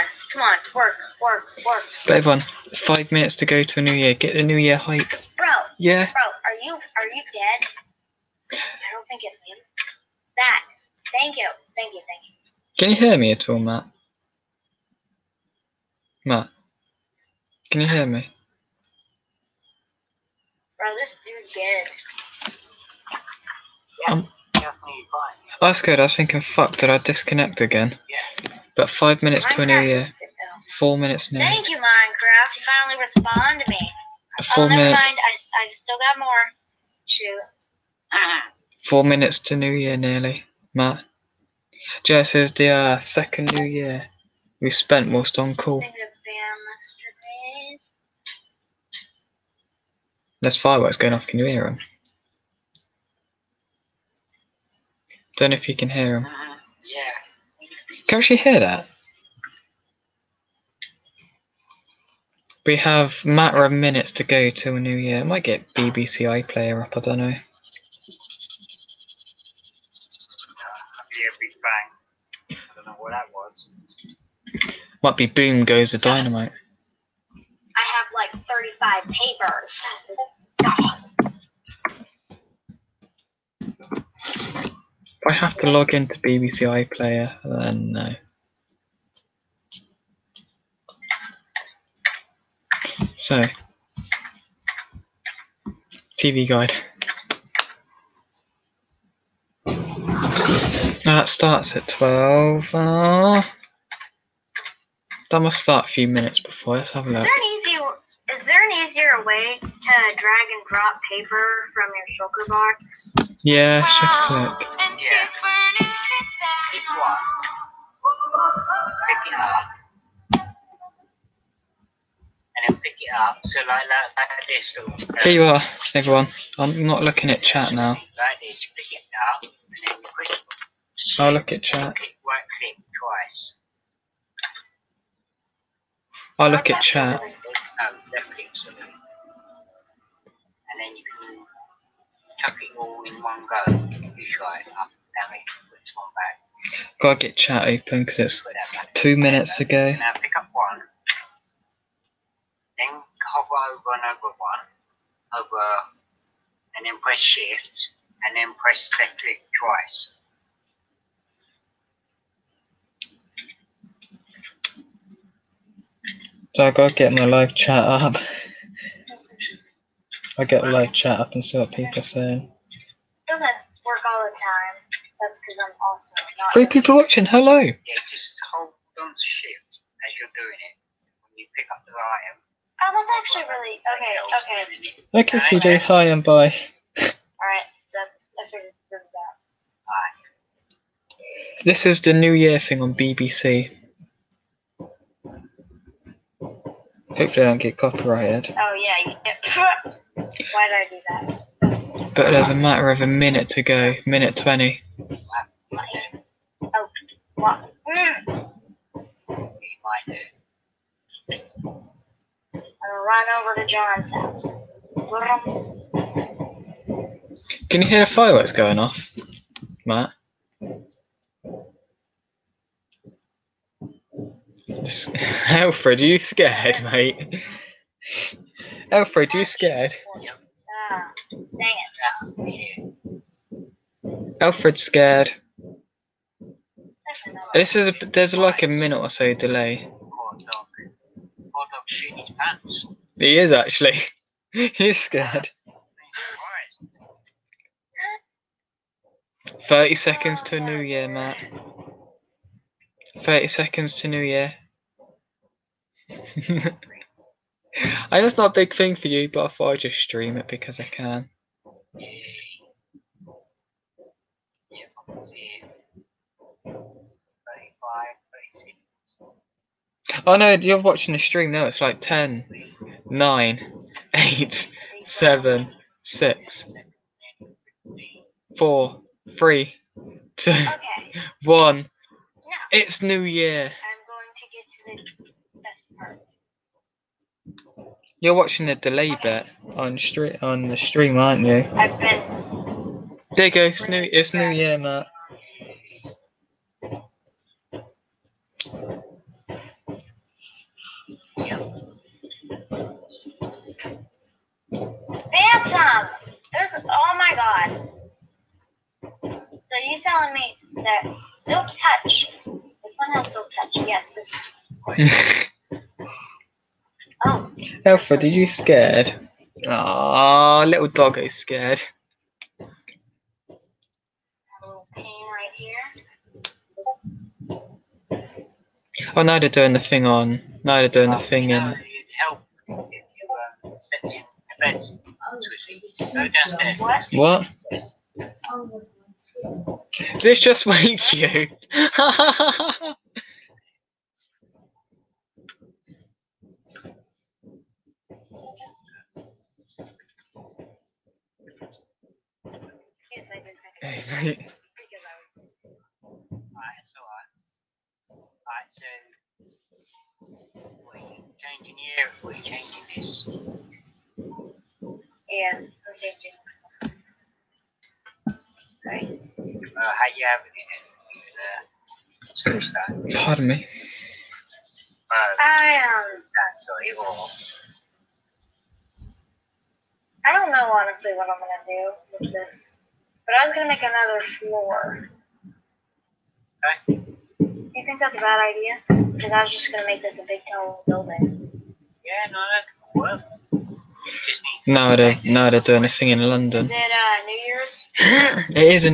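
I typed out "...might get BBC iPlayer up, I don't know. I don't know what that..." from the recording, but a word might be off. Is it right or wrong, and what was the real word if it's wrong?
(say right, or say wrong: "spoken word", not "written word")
right.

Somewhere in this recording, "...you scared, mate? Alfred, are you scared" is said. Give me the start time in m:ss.
3:46.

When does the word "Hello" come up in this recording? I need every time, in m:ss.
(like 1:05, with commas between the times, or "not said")
2:57.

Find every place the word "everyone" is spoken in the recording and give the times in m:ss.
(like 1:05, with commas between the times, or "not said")
0:02, 2:05.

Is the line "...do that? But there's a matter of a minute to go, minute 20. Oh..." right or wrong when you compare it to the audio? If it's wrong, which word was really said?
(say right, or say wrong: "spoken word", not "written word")
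right.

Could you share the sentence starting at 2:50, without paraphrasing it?
I get live chat, up and see what people are saying.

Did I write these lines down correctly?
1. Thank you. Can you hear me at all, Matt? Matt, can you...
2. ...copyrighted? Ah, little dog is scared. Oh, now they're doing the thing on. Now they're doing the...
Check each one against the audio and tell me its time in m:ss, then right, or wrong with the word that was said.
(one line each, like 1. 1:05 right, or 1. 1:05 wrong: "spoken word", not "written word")
1. 0:12 right
2. 5:18 wrong: "scared", not "copyrighted".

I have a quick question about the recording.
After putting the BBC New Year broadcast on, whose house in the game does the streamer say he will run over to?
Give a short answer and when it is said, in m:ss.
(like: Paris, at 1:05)
John's house, at 3:33.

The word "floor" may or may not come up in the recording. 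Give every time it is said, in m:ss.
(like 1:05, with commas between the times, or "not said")
6:24.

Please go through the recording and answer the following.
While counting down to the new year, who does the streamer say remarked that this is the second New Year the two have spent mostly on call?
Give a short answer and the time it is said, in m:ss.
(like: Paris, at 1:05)
Jess, at 0:42.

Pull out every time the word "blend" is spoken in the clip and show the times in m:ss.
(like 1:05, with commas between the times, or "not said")
not said.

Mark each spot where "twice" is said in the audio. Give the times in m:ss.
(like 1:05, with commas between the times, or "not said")
2:11, 2:39.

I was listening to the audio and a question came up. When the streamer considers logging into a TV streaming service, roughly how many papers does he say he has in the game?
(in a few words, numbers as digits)
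35.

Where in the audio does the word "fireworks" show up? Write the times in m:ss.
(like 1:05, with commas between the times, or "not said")
0:50, 3:38.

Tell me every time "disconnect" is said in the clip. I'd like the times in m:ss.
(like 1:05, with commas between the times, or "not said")
0:26.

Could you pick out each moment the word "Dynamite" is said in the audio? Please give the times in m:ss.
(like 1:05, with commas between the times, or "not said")
1:16.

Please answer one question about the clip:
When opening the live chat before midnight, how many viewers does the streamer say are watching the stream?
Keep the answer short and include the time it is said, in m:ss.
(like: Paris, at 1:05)
3, at 2:56.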